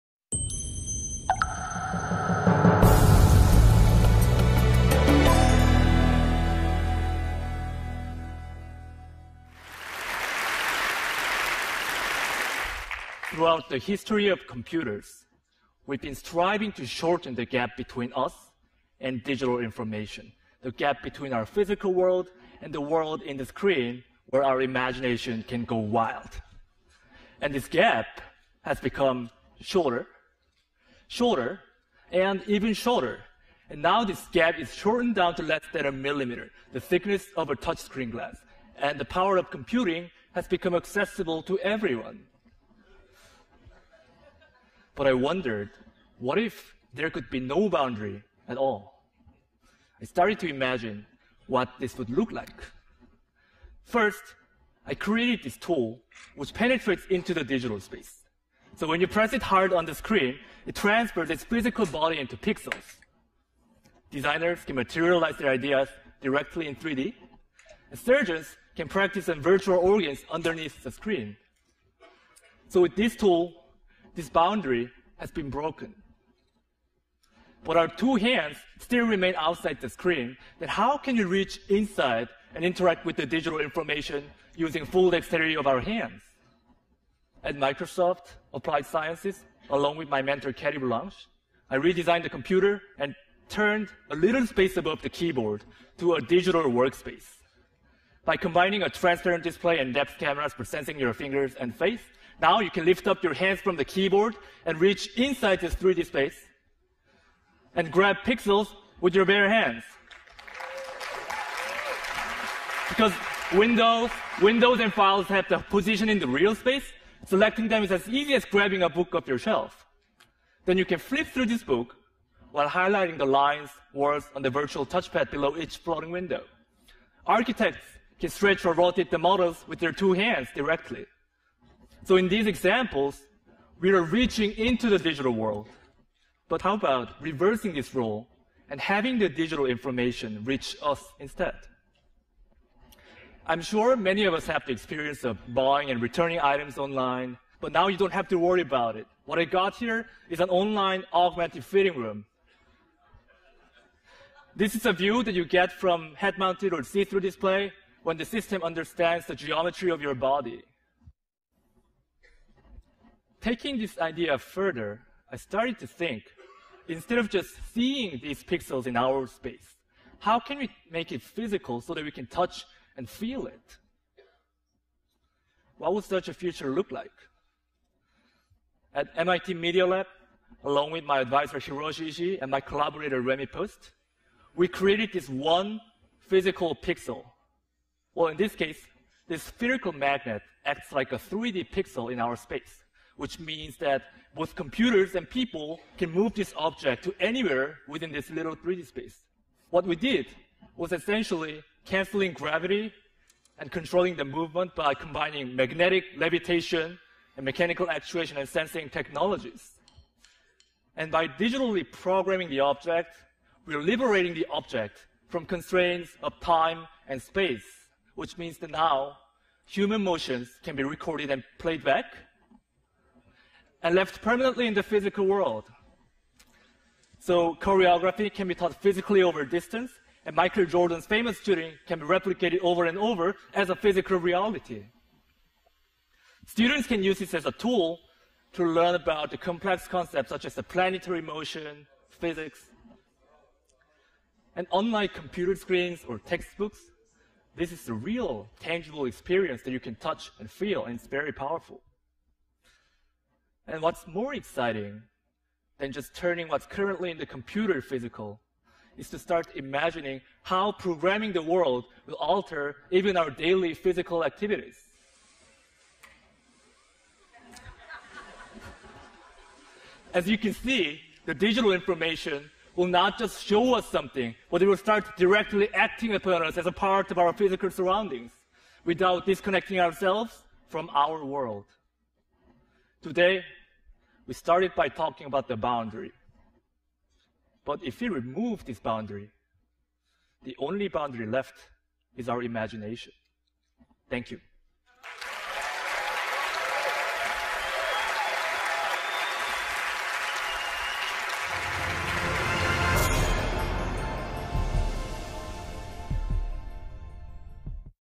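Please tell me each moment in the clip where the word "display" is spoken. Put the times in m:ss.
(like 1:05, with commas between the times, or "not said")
1:39, 2:37.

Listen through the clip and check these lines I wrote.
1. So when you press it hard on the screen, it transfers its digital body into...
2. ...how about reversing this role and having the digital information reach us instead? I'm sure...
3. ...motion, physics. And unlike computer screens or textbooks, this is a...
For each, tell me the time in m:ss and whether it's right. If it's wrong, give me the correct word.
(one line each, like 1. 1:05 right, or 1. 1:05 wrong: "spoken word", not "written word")
1. 0:58 wrong: "physical", not "digital"
2. 2:16 right
3. 4:01 right.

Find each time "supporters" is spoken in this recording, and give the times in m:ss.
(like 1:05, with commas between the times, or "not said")
not said.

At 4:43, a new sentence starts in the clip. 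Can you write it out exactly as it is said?
Today, we started by talking about the boundary.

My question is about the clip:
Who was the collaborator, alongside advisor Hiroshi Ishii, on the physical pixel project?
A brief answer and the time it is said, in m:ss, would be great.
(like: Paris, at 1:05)
Rehmi Post, at 3:03.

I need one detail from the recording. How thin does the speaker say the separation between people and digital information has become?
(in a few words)
less than a millimeter.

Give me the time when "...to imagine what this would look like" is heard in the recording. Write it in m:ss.
0:50.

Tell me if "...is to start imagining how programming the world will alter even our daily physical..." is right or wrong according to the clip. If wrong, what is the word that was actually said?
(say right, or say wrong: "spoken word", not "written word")
right.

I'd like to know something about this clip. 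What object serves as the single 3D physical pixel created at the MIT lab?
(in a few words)
spherical magnet.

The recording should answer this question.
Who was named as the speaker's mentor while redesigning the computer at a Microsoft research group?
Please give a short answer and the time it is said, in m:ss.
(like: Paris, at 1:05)
Cati Boulanger, at 1:30.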